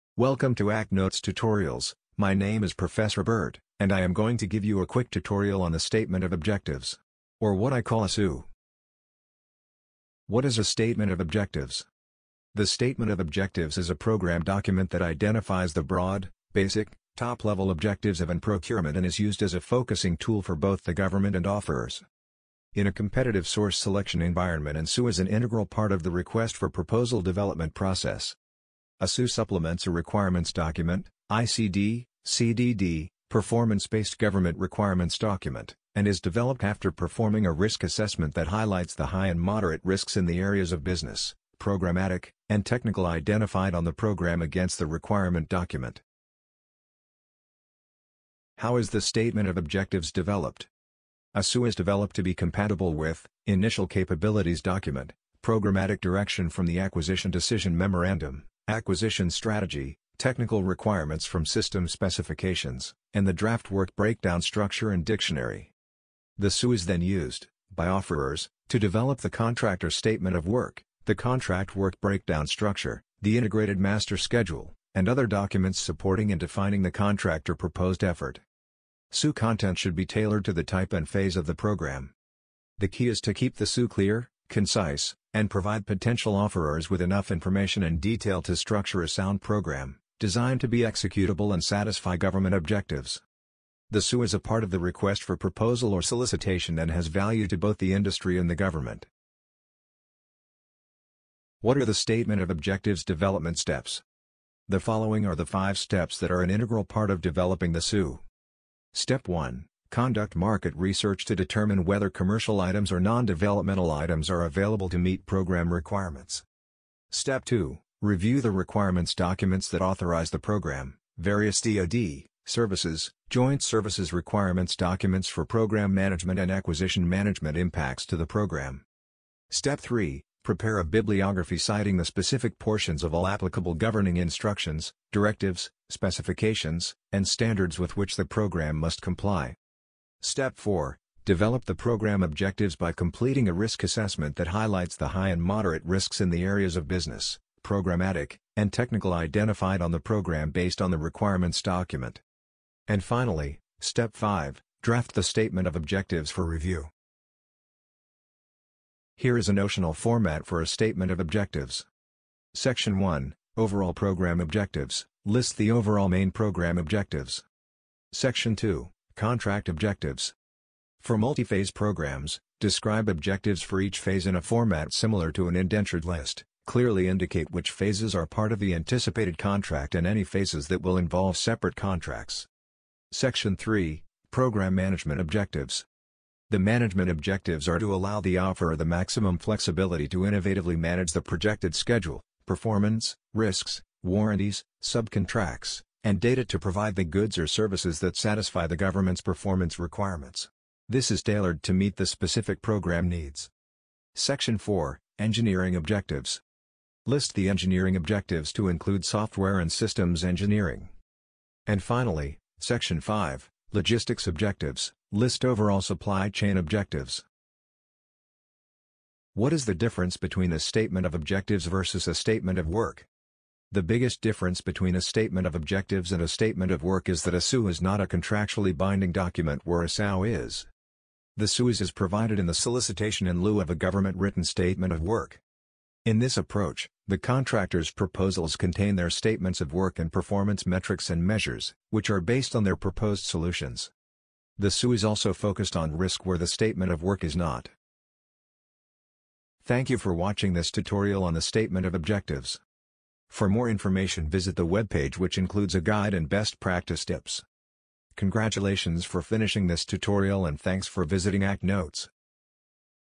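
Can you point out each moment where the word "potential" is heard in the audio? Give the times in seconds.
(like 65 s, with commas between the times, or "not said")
85 s.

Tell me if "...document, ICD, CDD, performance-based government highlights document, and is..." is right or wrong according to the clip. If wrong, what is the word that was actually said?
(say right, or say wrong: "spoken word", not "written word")
wrong: "requirements", not "highlights".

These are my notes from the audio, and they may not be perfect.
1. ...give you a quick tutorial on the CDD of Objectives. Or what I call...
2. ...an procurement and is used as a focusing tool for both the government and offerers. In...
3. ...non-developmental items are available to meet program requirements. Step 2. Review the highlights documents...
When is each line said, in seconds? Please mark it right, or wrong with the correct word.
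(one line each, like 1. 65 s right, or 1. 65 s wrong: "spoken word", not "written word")
1. 4 s wrong: "Statement", not "CDD"
2. 18 s right
3. 113 s wrong: "requirements", not "highlights".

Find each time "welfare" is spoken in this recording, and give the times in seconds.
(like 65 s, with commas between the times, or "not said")
not said.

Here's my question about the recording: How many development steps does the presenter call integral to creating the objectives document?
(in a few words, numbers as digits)
5.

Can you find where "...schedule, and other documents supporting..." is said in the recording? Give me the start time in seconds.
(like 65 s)
74 s.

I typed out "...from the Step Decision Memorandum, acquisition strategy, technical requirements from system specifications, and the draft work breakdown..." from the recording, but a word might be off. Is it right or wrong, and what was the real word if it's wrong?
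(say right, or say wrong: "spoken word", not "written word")
wrong: "Acquisition", not "Step".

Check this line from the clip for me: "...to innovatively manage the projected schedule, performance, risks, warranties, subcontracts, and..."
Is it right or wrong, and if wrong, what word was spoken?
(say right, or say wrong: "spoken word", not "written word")
right.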